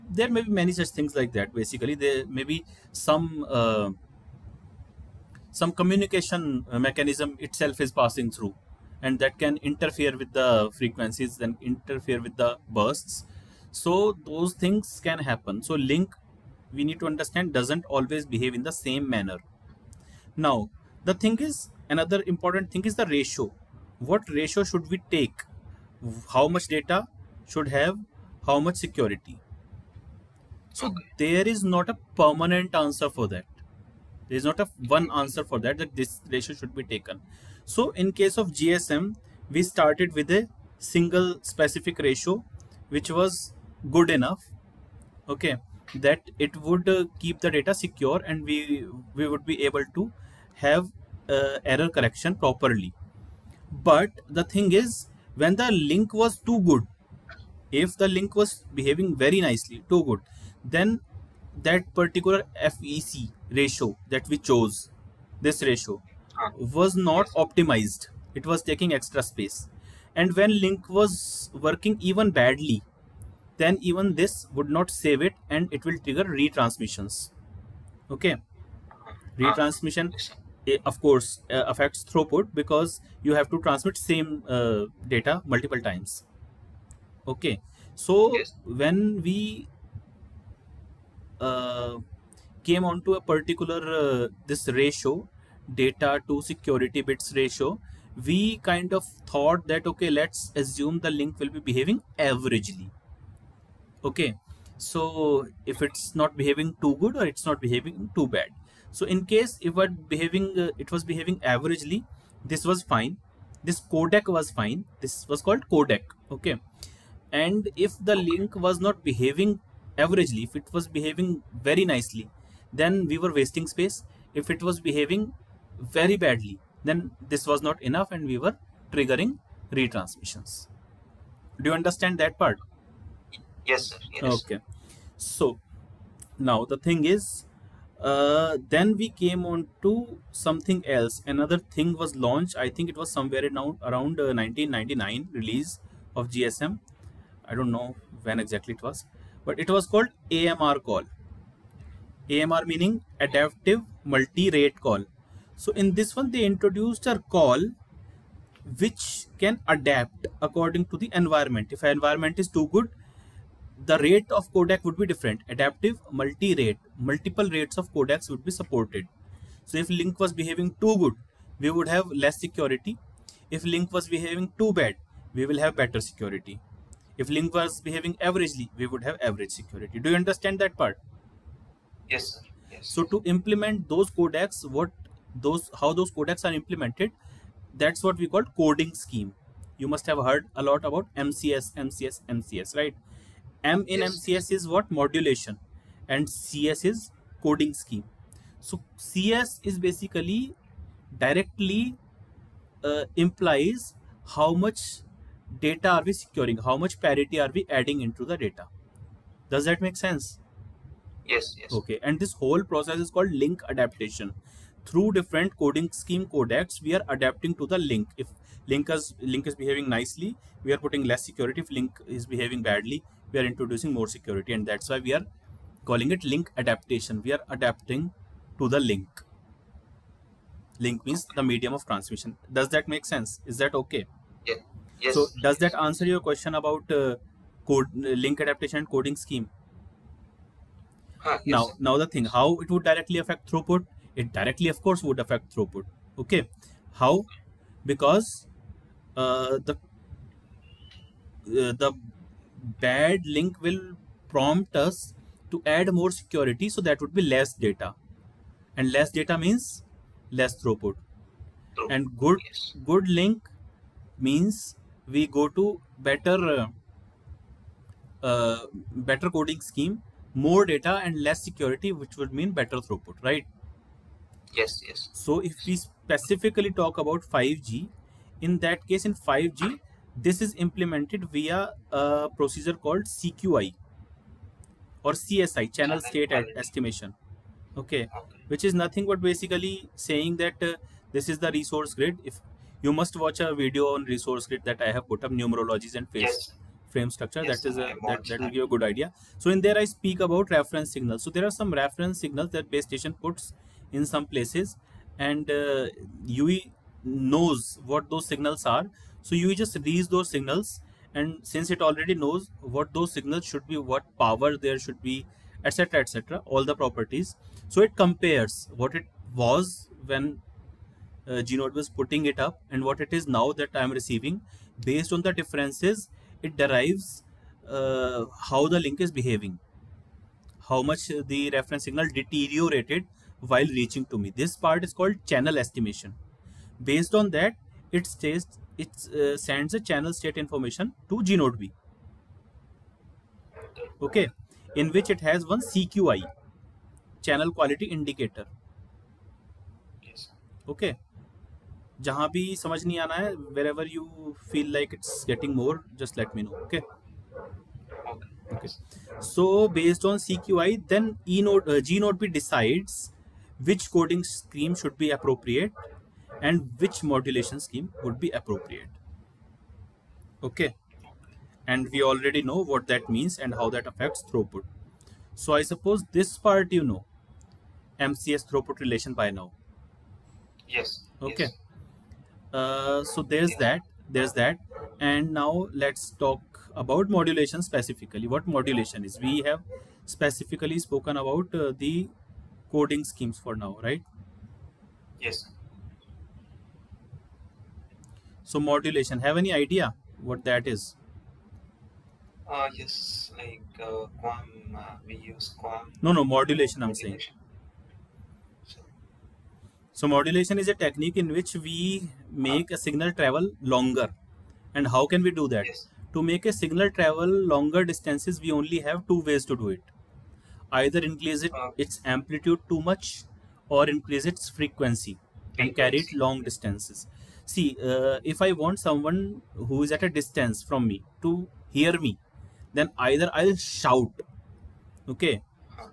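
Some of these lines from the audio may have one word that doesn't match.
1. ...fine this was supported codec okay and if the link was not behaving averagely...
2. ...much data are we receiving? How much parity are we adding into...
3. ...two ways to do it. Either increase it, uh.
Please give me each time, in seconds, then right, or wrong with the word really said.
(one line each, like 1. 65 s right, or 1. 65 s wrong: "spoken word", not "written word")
1. 114 s wrong: "called", not "supported"
2. 204 s wrong: "securing", not "receiving"
3. 419 s right.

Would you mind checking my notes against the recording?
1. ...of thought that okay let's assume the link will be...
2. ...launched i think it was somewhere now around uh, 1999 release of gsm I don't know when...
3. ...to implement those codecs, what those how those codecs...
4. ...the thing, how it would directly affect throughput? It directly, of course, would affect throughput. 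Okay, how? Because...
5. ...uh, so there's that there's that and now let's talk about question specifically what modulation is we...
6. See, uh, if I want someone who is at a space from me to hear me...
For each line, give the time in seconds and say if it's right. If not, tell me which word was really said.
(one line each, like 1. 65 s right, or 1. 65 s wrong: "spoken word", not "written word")
1. 98 s right
2. 142 s right
3. 183 s right
4. 241 s right
5. 382 s wrong: "modulation", not "question"
6. 427 s wrong: "distance", not "space".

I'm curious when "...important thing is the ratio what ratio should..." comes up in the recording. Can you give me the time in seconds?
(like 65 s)
22 s.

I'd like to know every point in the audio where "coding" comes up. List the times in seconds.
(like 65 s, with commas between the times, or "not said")
188 s, 197 s, 215 s, 238 s, 269 s, 363 s, 392 s.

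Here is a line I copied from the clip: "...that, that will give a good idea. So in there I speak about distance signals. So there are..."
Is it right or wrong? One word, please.
wrong.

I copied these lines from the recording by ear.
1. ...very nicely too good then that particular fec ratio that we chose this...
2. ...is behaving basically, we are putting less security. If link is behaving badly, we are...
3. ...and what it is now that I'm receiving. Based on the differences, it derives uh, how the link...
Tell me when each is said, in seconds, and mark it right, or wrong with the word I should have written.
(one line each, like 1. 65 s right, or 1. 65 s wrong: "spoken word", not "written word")
1. 59 s right
2. 219 s wrong: "nicely", not "basically"
3. 322 s right.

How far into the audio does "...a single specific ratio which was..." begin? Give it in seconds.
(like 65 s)
40 s.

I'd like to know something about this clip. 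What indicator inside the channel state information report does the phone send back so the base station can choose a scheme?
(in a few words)
CQI (channel quality indicator).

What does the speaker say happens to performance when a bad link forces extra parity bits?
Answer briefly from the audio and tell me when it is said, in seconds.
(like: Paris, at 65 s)
less throughput, at 260 s.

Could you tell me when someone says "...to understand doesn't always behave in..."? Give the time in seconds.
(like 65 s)
16 s.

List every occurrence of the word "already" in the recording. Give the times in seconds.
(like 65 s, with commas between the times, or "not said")
311 s, 372 s.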